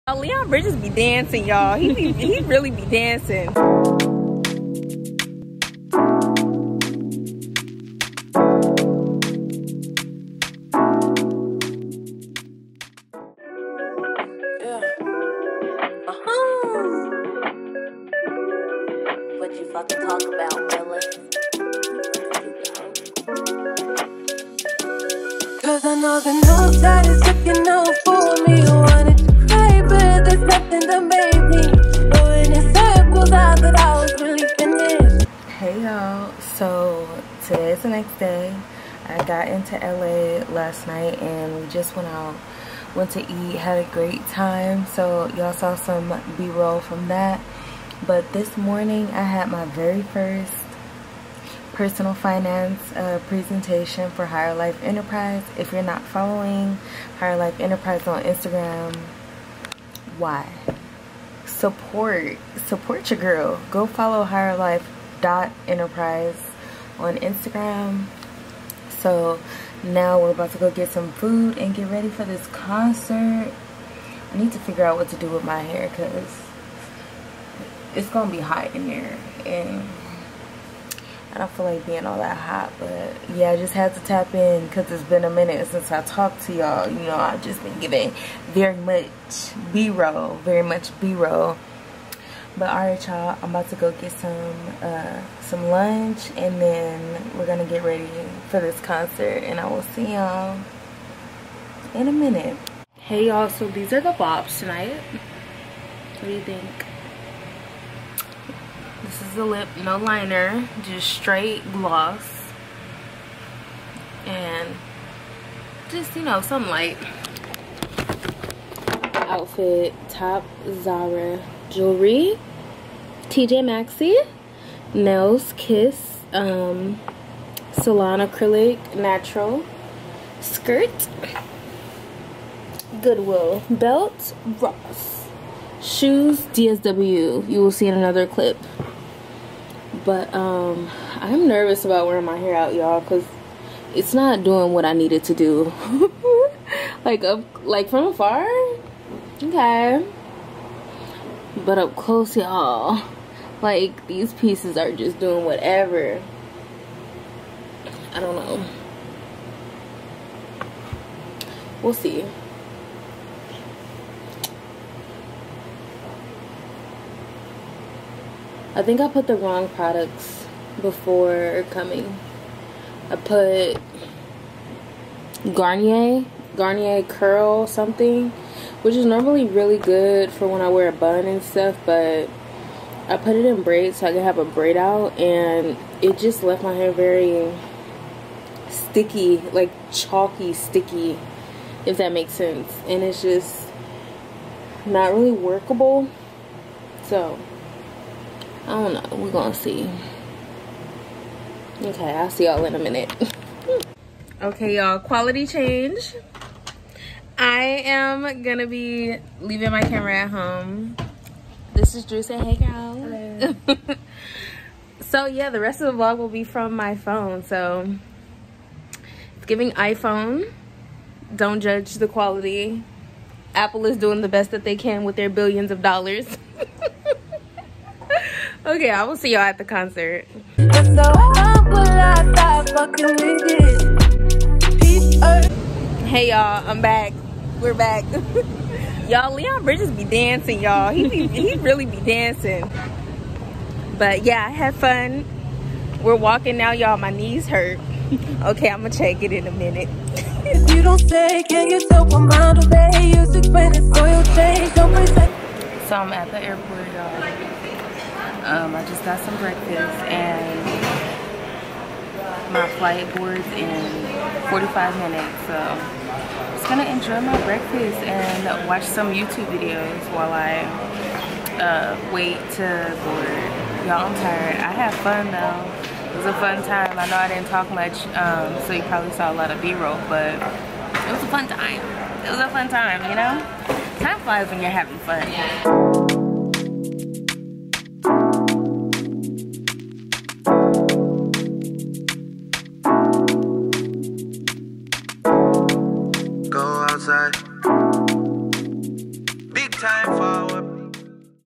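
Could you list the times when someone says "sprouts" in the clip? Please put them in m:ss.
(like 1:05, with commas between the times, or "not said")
not said.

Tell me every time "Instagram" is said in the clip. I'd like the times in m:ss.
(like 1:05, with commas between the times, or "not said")
0:58, 1:07.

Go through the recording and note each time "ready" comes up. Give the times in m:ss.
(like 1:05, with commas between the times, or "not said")
1:11, 1:37.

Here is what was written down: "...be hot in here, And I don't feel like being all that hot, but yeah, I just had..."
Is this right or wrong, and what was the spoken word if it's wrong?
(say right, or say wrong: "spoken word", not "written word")
right.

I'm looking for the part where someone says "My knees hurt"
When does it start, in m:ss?
4:06.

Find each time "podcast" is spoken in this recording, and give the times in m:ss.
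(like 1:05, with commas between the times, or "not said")
not said.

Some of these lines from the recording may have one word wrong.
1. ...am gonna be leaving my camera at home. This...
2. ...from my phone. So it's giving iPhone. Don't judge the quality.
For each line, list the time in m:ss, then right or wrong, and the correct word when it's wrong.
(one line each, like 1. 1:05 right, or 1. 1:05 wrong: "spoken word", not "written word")
1. 3:27 right
2. 3:36 right.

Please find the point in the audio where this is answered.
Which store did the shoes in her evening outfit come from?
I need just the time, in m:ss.
2:16.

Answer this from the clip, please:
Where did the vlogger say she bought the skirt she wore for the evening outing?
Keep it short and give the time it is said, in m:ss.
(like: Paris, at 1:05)
Goodwill, at 2:13.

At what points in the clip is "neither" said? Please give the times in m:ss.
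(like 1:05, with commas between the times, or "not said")
not said.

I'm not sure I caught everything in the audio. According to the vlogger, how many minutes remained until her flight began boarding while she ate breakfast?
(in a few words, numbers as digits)
45.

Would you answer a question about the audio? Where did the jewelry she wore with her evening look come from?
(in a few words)
TJ Maxx.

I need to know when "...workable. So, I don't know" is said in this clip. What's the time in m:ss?
3:15.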